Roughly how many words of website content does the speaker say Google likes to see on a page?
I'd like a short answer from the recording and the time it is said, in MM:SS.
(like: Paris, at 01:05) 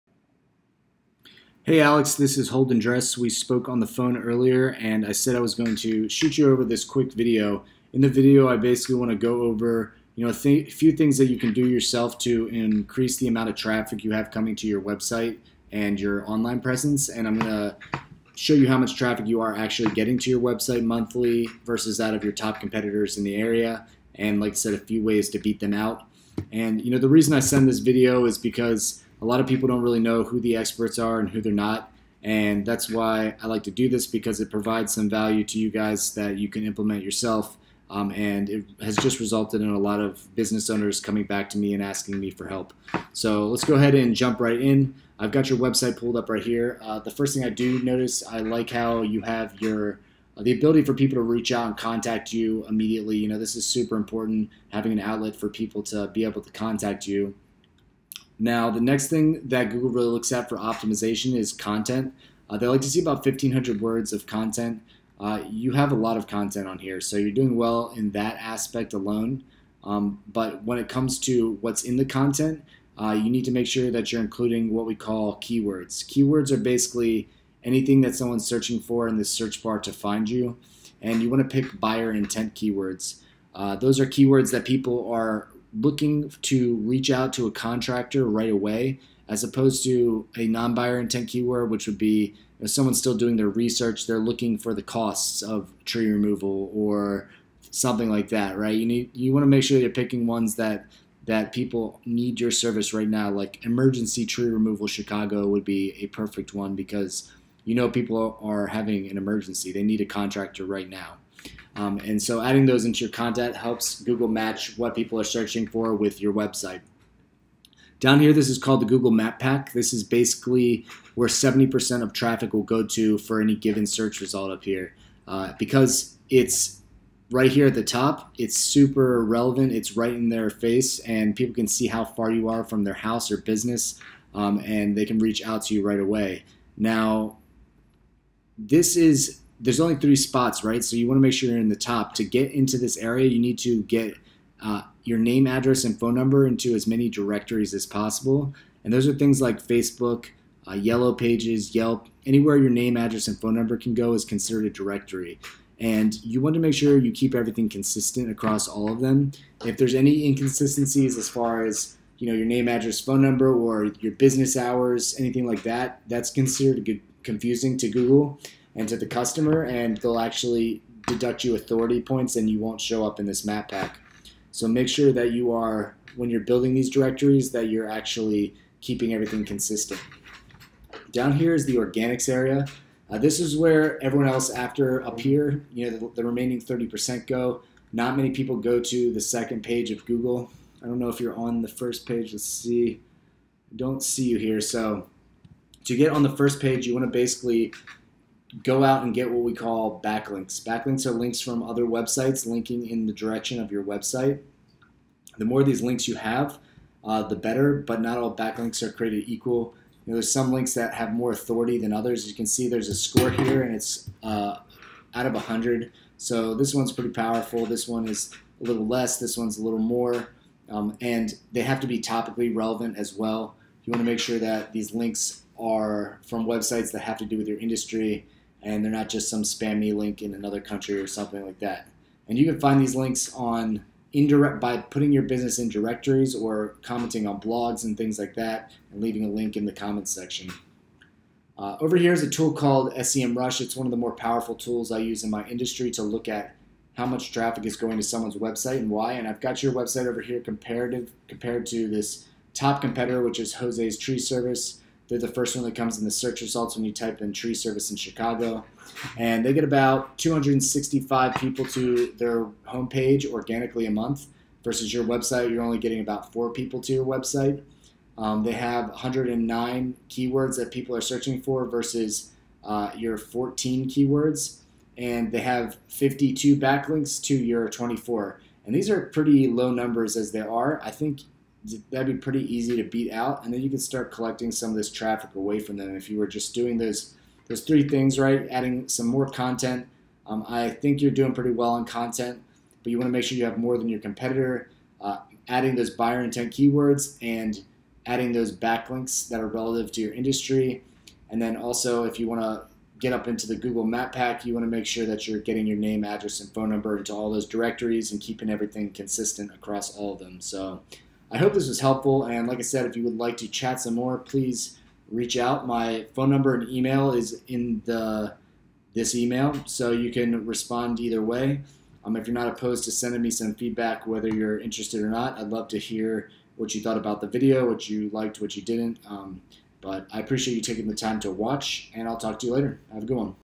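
1,500, at 01:03.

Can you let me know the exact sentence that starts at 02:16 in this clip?
Now, this is there's only three spots, right?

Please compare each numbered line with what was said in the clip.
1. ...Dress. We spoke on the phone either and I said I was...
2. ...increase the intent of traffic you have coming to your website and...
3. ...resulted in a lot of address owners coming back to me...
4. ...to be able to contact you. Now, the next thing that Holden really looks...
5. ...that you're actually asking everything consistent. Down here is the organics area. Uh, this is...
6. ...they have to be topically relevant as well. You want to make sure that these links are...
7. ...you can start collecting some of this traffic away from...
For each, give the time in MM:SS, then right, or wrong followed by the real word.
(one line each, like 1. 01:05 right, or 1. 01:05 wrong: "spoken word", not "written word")
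1. 00:02 wrong: "earlier", not "either"
2. 00:12 wrong: "amount", not "intent"
3. 00:39 wrong: "business", not "address"
4. 00:55 wrong: "Google", not "Holden"
5. 02:57 wrong: "keeping", not "asking"
6. 03:41 right
7. 04:43 right.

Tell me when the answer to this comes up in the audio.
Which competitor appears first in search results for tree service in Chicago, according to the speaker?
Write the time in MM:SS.
04:13.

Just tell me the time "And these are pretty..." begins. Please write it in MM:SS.
04:38.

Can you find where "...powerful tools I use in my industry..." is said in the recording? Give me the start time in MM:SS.
04:04.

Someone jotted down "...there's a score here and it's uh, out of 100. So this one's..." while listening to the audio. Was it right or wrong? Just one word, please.
right.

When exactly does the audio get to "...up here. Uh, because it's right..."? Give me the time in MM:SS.
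02:04.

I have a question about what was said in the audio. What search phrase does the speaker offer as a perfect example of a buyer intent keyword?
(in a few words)
emergency tree removal Chicago.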